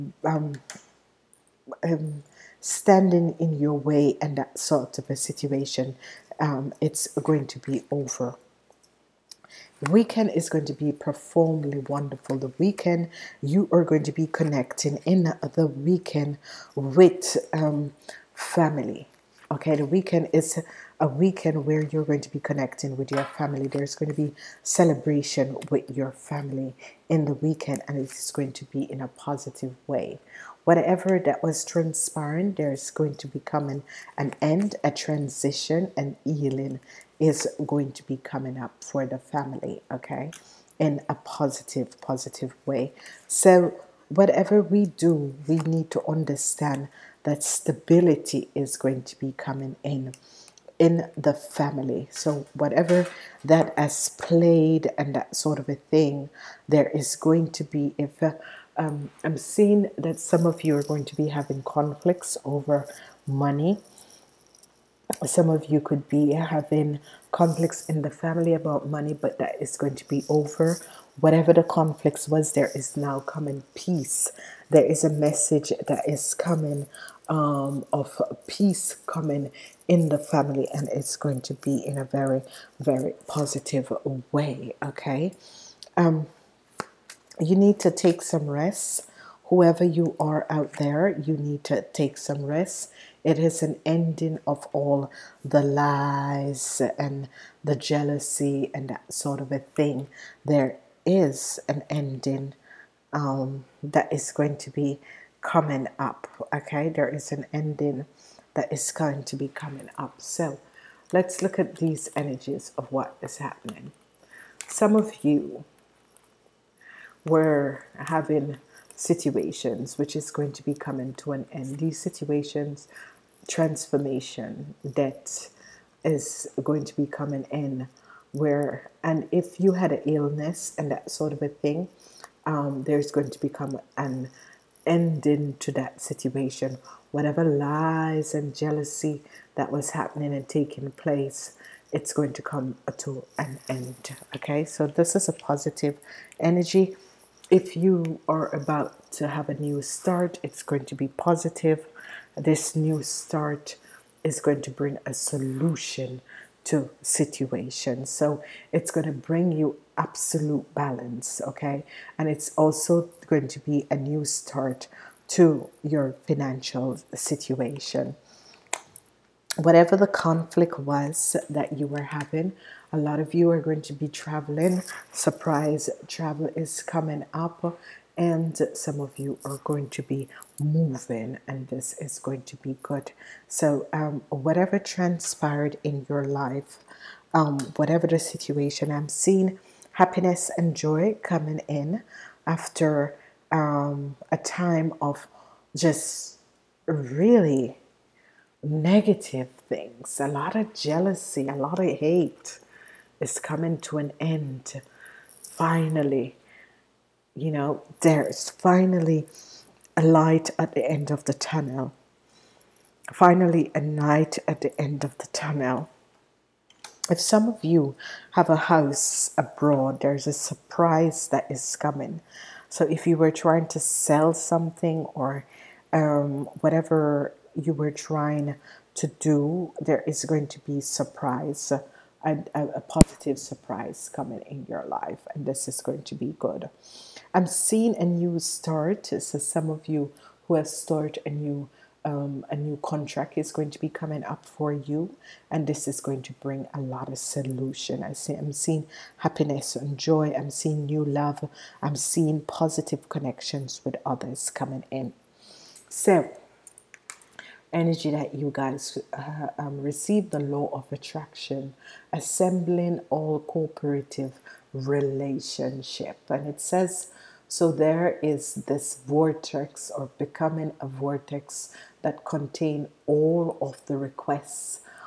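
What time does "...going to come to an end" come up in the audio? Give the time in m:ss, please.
2:22.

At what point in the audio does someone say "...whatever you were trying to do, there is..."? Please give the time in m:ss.
3:46.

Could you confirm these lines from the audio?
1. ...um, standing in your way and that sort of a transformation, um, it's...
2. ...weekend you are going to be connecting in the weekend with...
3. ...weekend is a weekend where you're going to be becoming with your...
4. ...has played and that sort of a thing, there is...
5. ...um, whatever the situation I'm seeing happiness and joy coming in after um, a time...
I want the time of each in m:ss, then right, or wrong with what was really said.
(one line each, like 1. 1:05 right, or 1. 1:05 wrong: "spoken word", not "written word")
1. 0:01 wrong: "situation", not "transformation"
2. 0:12 right
3. 0:19 wrong: "connecting", not "becoming"
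4. 0:53 right
5. 3:07 right.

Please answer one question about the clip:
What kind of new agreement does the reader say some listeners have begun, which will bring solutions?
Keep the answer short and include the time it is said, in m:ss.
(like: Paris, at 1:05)
A new contract, at 4:02.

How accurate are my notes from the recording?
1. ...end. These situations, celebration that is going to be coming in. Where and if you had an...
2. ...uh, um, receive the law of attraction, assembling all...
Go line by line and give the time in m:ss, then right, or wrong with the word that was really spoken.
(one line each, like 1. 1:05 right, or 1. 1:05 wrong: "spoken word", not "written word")
1. 2:01 wrong: "transformation", not "celebration"
2. 4:19 right.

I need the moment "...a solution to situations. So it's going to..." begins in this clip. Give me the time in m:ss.
2:35.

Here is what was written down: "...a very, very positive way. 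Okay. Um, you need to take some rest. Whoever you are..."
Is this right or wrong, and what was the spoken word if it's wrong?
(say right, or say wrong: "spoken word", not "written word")
right.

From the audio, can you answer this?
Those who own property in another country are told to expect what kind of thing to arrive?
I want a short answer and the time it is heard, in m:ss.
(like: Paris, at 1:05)
A surprise, at 3:40.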